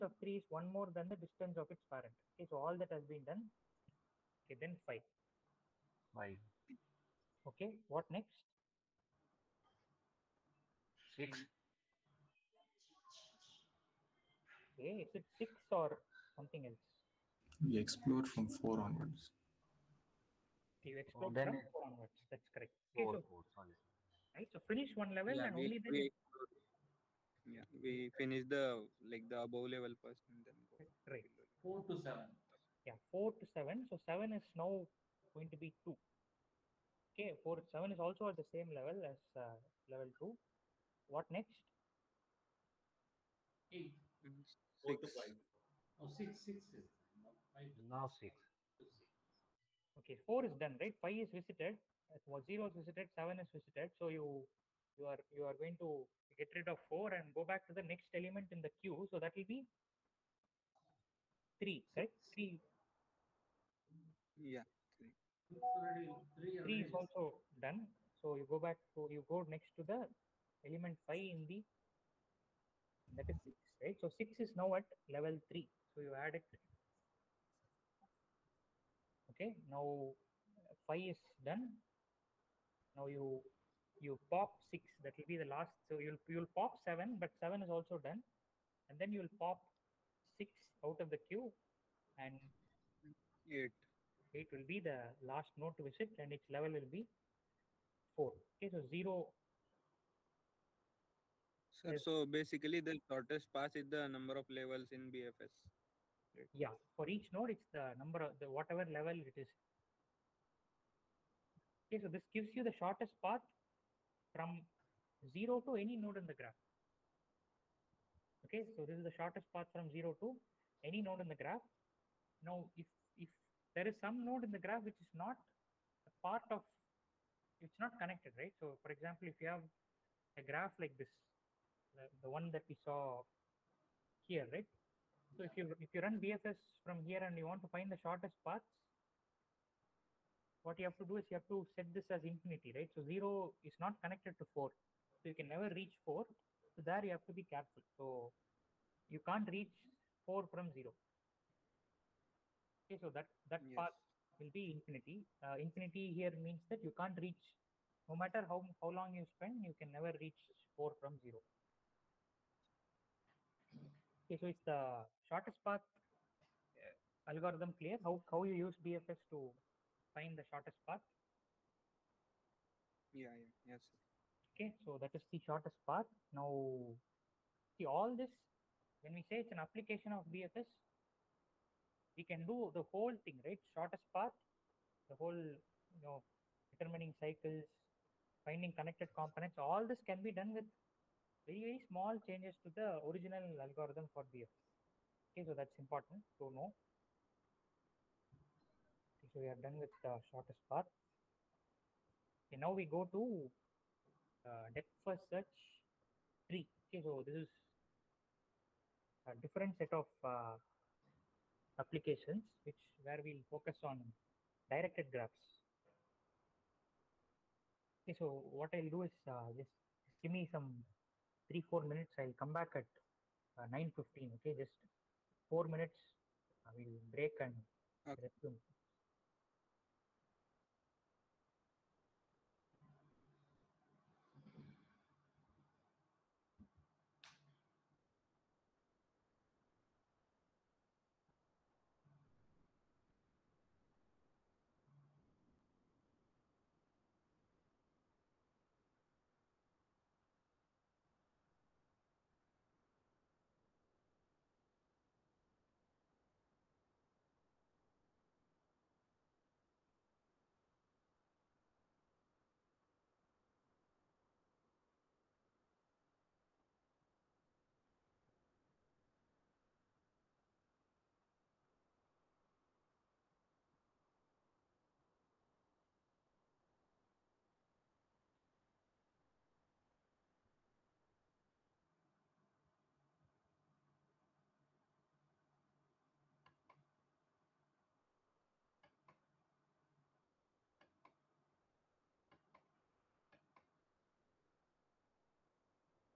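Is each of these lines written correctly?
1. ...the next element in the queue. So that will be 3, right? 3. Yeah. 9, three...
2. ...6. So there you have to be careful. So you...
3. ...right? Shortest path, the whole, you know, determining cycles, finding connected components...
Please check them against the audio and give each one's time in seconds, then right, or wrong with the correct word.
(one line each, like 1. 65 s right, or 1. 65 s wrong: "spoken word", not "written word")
1. 57 s wrong: "3", not "9"
2. 146 s wrong: "4", not "6"
3. 183 s right.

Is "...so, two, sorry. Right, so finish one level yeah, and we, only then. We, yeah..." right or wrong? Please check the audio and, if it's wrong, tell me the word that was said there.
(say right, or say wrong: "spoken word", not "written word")
wrong: "four", not "two".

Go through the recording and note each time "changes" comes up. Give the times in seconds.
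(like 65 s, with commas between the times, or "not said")
192 s.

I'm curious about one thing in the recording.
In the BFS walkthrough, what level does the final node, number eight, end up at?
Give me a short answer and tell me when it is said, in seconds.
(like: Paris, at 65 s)
4, at 96 s.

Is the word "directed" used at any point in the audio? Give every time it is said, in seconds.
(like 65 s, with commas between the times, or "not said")
214 s.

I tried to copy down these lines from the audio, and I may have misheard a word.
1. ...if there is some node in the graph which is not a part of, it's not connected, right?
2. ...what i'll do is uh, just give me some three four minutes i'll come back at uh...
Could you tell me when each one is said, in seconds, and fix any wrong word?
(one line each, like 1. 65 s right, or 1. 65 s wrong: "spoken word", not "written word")
1. 123 s right
2. 218 s right.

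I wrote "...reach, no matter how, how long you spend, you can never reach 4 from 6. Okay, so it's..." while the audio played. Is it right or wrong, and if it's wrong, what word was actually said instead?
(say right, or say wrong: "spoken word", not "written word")
wrong: "0", not "6".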